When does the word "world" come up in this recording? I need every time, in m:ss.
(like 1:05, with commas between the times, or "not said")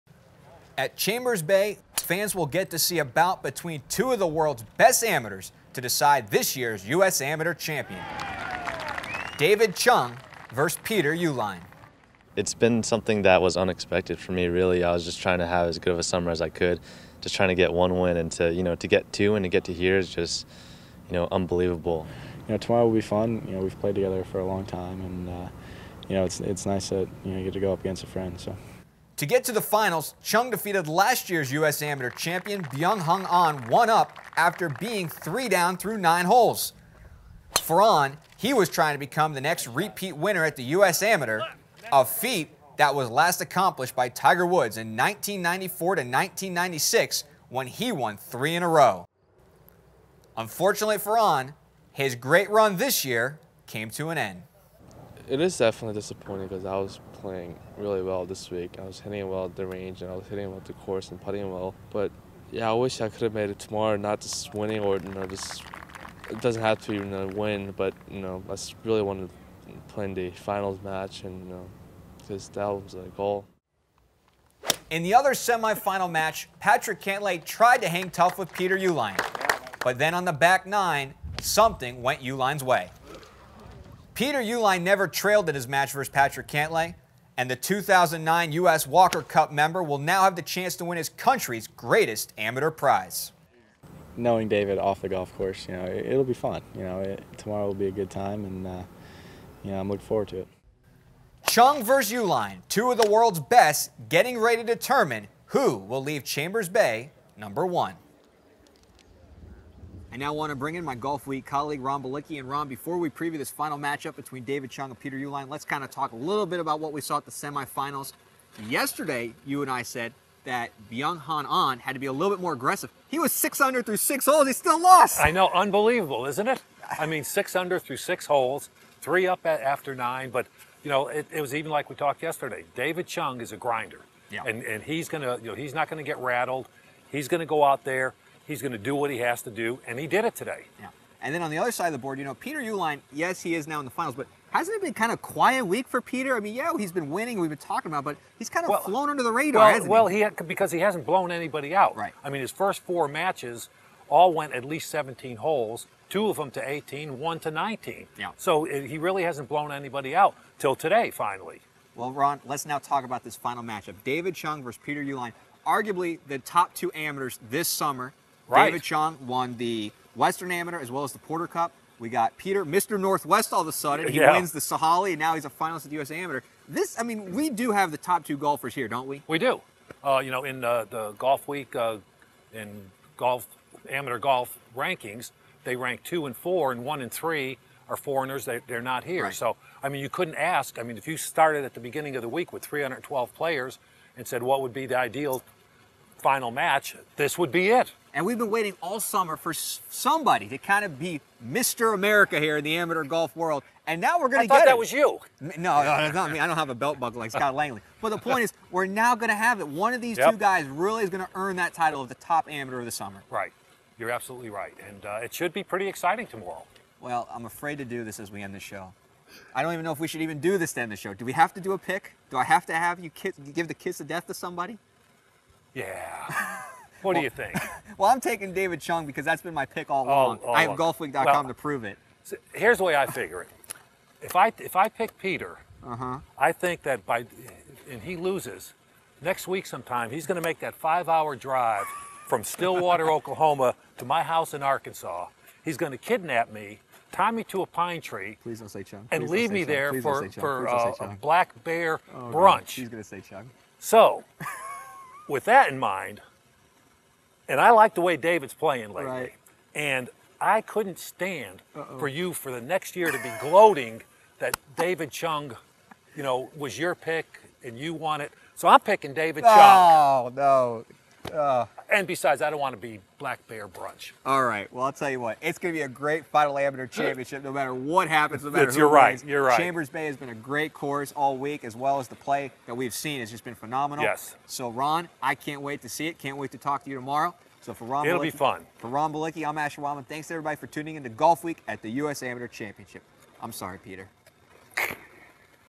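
0:04, 1:43, 3:23.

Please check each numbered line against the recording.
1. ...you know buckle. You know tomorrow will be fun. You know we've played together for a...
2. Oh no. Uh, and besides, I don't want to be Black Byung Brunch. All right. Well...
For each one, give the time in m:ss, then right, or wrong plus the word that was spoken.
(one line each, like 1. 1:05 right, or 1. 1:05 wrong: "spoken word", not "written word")
1. 0:21 wrong: "unbelievable", not "buckle"
2. 4:29 wrong: "Bear", not "Byung".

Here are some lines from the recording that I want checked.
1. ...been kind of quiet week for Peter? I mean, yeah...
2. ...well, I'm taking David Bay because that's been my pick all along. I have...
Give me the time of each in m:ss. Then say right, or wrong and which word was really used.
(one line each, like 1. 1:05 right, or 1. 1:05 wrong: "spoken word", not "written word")
1. 2:24 right
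2. 3:47 wrong: "Chung", not "Bay".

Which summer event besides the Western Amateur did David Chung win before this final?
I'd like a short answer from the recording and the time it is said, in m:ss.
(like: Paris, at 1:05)
Porter Cup, at 2:51.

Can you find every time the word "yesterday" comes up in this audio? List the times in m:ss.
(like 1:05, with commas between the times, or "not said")
1:58, 2:12.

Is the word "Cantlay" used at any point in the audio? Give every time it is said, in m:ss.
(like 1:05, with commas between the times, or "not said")
1:17, 1:26.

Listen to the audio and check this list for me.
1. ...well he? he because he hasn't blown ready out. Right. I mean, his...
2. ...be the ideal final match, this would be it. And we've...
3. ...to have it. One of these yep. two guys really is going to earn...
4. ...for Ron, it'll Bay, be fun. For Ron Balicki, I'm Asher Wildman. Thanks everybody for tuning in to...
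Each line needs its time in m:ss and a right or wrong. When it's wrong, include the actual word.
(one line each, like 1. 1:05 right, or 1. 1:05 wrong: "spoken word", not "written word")
1. 2:29 wrong: "anybody", not "ready"
2. 3:14 right
3. 3:29 right
4. 4:47 wrong: "Balicki", not "Bay".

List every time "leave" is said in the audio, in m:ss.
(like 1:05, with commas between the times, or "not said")
1:46, 4:09.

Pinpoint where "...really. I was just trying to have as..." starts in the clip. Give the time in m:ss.
0:14.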